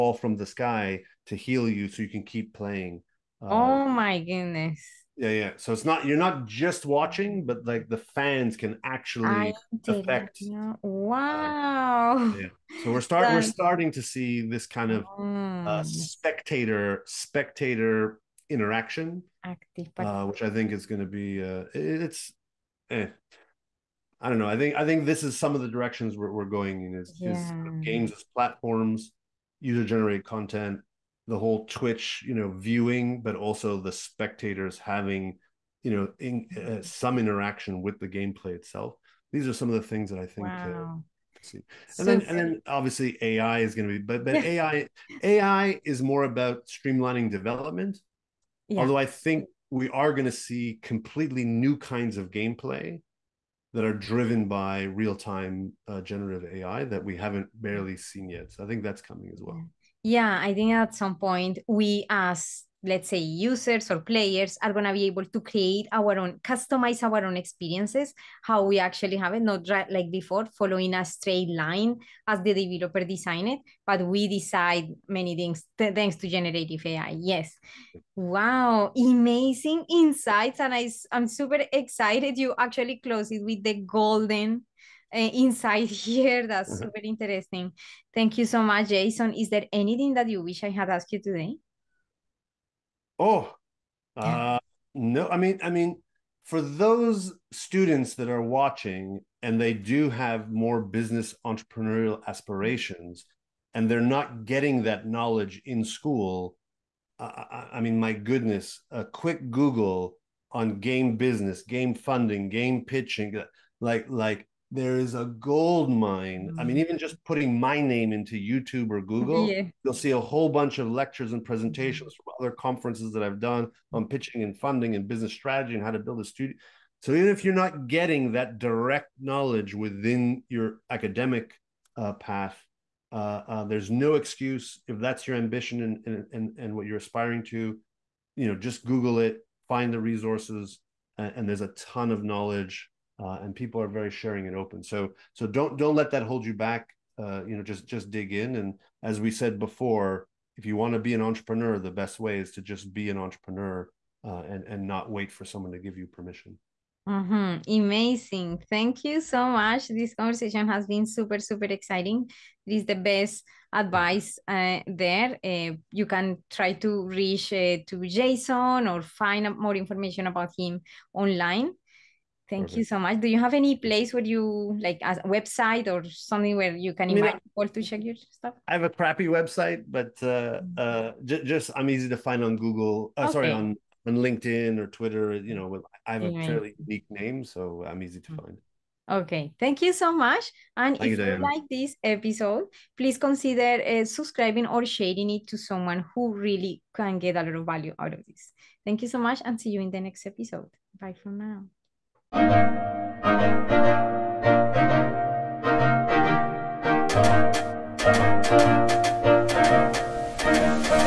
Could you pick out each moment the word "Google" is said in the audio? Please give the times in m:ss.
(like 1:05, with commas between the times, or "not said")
1:49, 1:59, 2:18, 3:02.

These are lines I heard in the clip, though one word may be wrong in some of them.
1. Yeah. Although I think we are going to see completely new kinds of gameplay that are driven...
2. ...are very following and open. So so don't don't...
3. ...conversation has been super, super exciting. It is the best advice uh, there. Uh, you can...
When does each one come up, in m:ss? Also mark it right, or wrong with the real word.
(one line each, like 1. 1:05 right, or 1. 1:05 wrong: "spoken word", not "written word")
1. 0:48 right
2. 2:23 wrong: "sharing", not "following"
3. 2:40 right.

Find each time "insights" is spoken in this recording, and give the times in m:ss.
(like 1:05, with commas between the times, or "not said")
1:19, 1:25.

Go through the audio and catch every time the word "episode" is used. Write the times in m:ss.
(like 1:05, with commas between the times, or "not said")
3:12, 3:20.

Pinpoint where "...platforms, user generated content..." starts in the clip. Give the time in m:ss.
0:28.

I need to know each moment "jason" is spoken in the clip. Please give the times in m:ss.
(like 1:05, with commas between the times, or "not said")
1:28, 2:48.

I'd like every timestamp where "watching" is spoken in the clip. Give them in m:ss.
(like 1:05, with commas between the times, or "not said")
0:06, 1:38.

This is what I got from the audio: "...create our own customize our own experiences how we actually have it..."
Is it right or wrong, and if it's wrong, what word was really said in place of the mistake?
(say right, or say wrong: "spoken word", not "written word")
right.